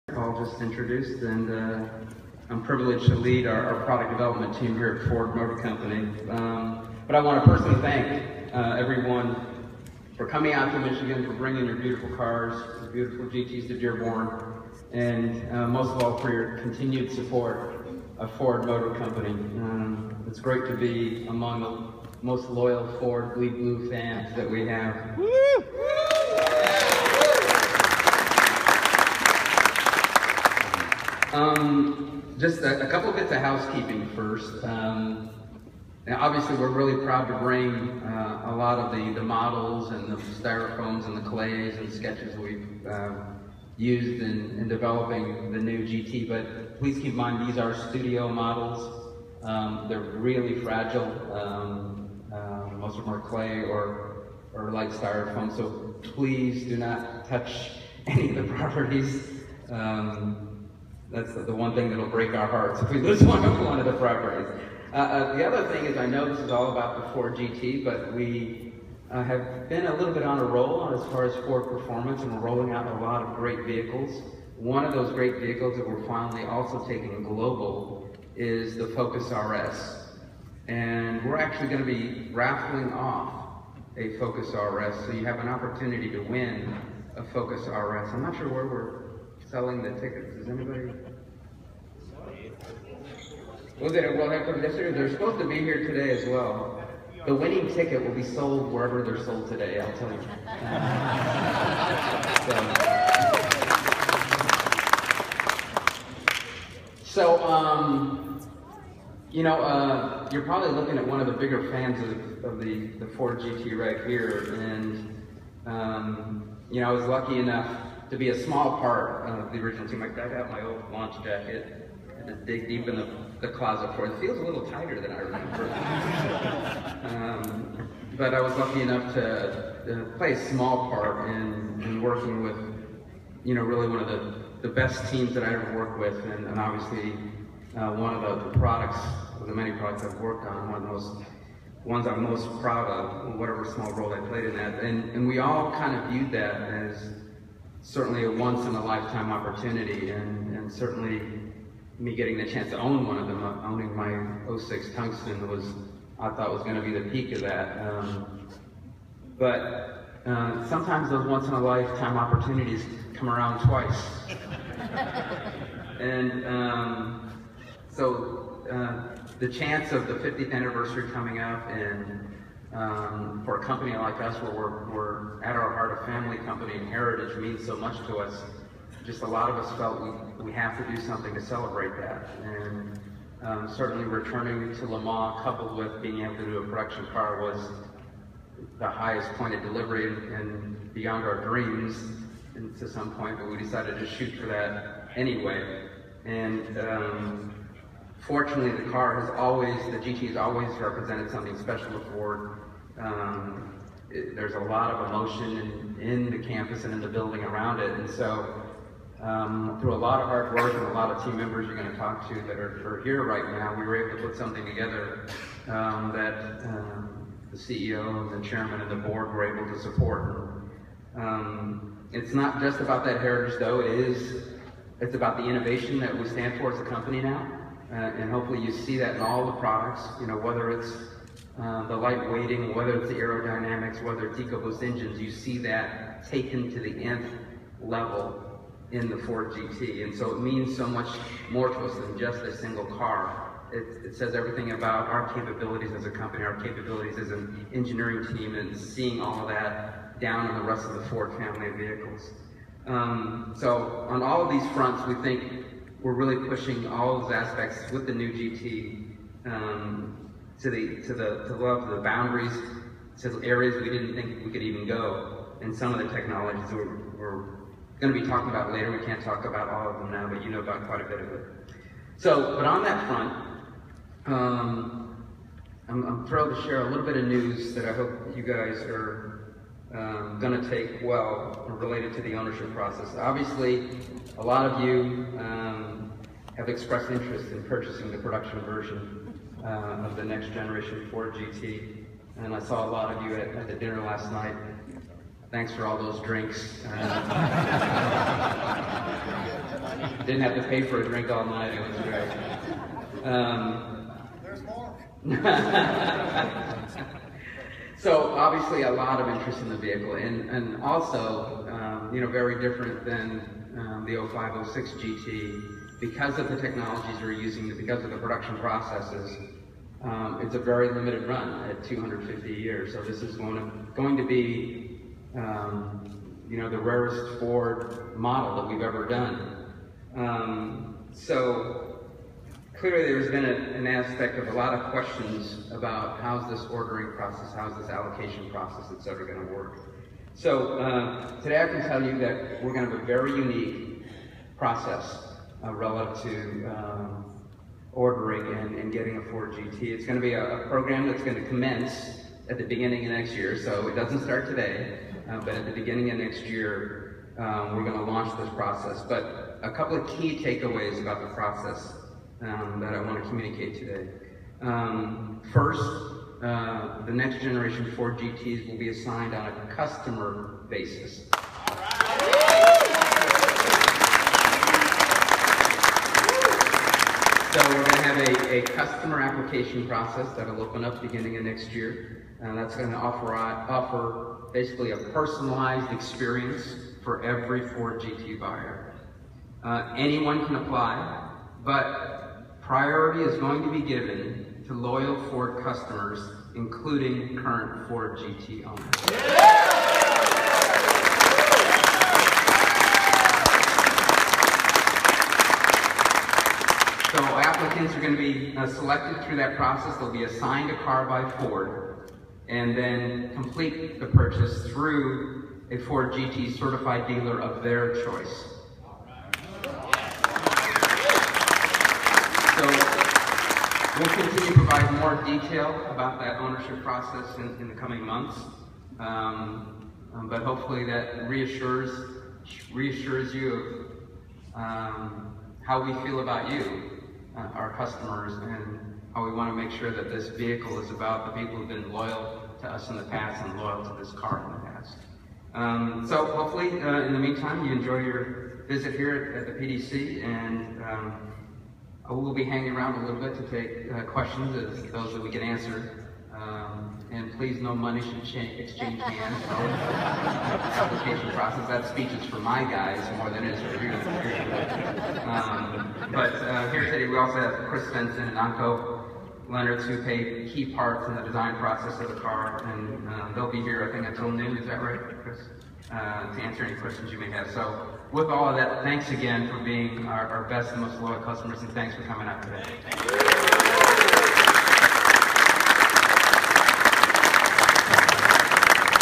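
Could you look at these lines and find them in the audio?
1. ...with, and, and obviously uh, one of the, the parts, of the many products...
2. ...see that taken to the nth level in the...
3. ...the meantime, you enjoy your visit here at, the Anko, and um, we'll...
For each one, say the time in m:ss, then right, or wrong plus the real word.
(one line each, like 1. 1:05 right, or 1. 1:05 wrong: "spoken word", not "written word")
1. 2:15 wrong: "products", not "parts"
2. 3:55 right
3. 7:27 wrong: "PDC", not "Anko".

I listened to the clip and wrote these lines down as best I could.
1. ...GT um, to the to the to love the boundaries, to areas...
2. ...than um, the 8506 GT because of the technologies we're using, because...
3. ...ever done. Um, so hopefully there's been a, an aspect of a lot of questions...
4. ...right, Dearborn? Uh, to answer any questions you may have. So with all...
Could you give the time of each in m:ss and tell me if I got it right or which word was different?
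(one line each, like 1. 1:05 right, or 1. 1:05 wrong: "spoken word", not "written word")
1. 4:18 right
2. 5:13 wrong: "0506", not "8506"
3. 5:28 wrong: "clearly", not "hopefully"
4. 7:54 wrong: "Chris", not "Dearborn".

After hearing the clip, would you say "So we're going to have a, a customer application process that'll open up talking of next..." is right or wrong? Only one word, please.
wrong.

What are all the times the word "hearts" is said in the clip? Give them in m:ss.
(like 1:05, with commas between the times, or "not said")
1:02, 2:55.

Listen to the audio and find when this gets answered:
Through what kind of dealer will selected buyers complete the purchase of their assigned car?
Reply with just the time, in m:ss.
6:55.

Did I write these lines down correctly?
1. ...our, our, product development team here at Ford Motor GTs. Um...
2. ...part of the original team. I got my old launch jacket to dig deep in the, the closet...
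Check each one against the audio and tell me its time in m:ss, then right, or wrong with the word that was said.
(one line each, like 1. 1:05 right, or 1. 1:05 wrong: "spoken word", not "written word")
1. 0:03 wrong: "Company", not "GTs"
2. 1:58 right.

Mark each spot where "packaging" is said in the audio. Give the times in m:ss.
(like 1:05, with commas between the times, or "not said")
not said.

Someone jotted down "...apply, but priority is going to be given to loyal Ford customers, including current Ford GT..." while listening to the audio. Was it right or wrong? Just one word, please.
right.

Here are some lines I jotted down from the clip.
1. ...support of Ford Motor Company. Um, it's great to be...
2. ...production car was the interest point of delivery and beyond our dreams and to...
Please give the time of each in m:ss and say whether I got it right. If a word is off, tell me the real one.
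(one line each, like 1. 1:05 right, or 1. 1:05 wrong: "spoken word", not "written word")
1. 0:17 right
2. 3:06 wrong: "highest", not "interest".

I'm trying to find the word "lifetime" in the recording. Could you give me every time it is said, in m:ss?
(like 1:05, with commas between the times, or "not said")
2:28, 2:41.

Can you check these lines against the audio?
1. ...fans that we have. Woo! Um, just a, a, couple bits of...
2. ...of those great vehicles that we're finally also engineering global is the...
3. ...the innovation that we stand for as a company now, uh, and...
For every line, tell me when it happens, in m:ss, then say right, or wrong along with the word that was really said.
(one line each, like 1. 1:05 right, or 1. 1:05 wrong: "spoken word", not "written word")
1. 0:23 right
2. 1:14 wrong: "taking", not "engineering"
3. 3:45 right.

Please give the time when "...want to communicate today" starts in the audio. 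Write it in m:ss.
6:03.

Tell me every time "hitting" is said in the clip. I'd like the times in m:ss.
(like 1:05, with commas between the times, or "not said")
not said.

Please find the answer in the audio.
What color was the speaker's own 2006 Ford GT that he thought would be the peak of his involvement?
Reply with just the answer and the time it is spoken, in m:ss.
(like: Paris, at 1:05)
Tungsten, at 2:34.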